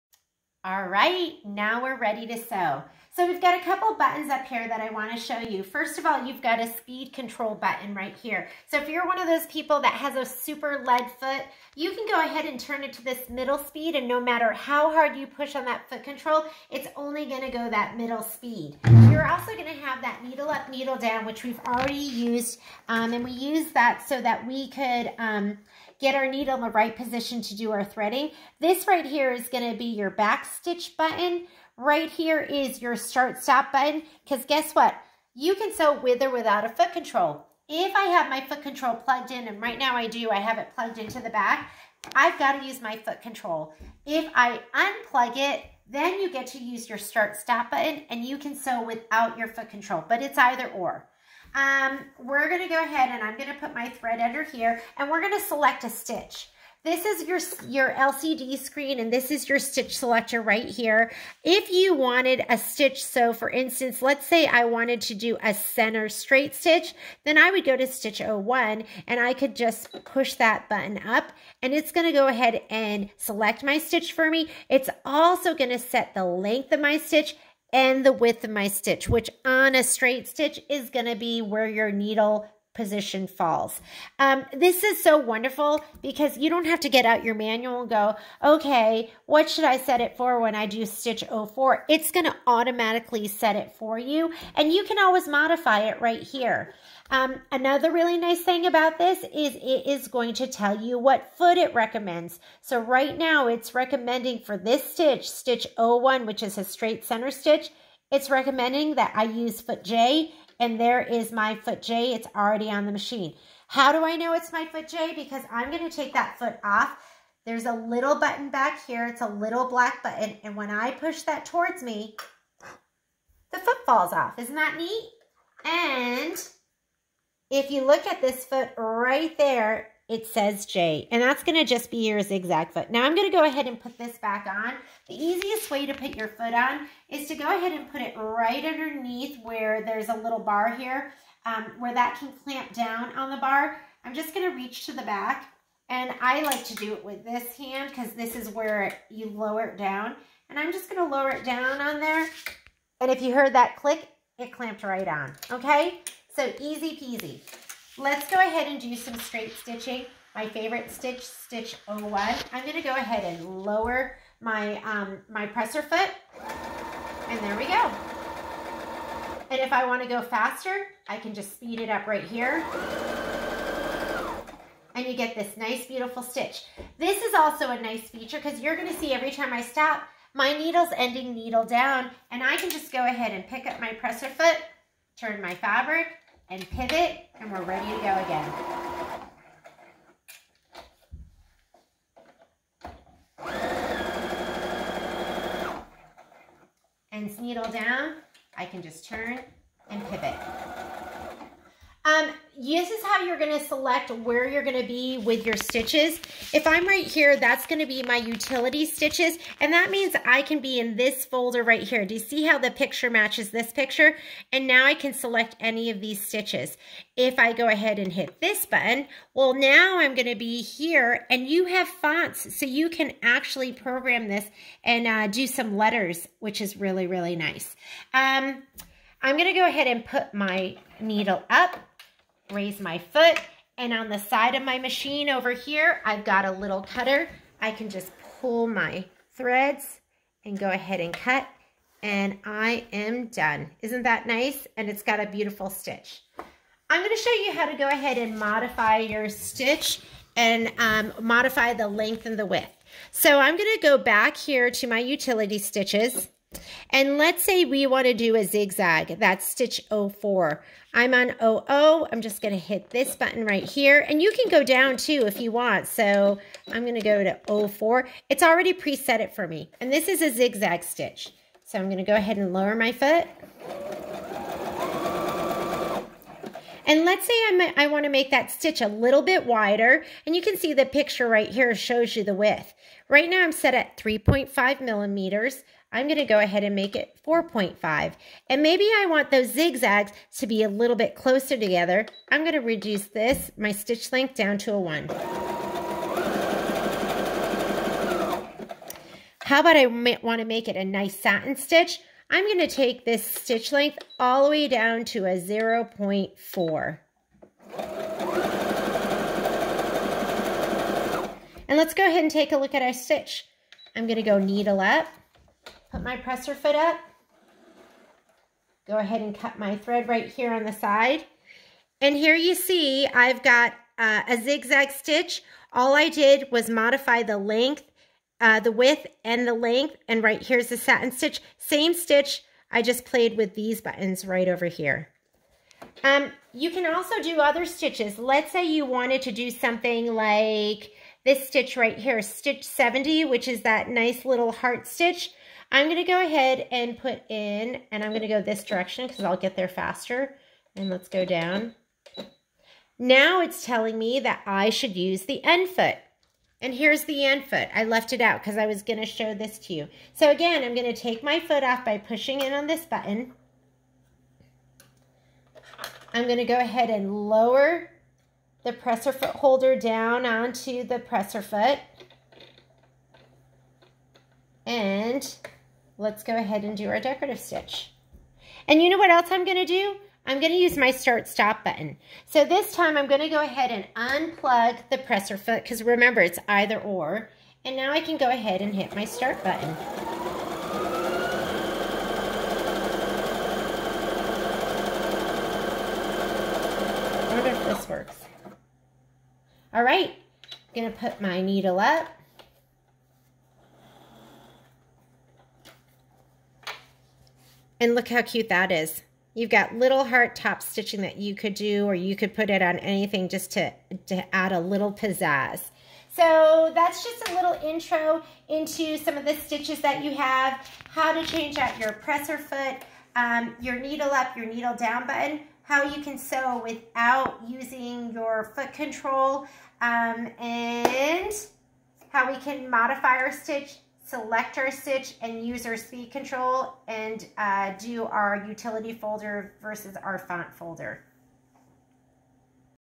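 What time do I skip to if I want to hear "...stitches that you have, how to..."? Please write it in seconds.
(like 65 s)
419 s.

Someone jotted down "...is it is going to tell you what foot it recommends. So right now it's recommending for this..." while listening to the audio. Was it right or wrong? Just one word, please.
right.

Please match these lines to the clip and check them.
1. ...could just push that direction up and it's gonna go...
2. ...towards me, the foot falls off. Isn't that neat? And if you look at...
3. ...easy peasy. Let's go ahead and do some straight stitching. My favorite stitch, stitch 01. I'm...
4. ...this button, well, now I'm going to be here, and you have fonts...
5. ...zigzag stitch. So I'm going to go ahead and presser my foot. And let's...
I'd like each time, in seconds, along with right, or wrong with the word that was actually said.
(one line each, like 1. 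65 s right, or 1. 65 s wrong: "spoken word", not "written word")
1. 69 s wrong: "button", not "direction"
2. 121 s right
3. 156 s right
4. 218 s right
5. 270 s wrong: "lower", not "presser".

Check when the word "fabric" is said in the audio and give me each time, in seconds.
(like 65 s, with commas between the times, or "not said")
185 s.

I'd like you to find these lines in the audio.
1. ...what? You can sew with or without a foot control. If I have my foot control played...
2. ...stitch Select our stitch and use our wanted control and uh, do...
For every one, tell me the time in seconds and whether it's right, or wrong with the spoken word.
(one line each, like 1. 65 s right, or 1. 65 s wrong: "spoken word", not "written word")
1. 34 s wrong: "plugged", not "played"
2. 433 s wrong: "speed", not "wanted".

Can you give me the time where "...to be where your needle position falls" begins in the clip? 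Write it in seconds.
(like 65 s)
81 s.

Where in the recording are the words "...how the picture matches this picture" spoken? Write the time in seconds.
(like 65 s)
212 s.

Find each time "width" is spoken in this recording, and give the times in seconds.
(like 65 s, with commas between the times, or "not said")
78 s, 252 s, 282 s, 328 s.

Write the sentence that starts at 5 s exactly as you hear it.
First of all, you've got a speed control button right here.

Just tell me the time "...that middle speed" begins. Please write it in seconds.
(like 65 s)
17 s.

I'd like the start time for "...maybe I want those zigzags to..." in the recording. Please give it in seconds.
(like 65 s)
288 s.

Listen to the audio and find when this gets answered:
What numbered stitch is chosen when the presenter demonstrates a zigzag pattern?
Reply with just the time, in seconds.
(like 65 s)
259 s.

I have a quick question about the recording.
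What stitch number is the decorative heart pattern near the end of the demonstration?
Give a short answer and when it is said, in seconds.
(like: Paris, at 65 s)
70, at 342 s.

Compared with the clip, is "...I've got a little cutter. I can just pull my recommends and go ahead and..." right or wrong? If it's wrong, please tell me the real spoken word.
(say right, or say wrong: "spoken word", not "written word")
wrong: "threads", not "recommends".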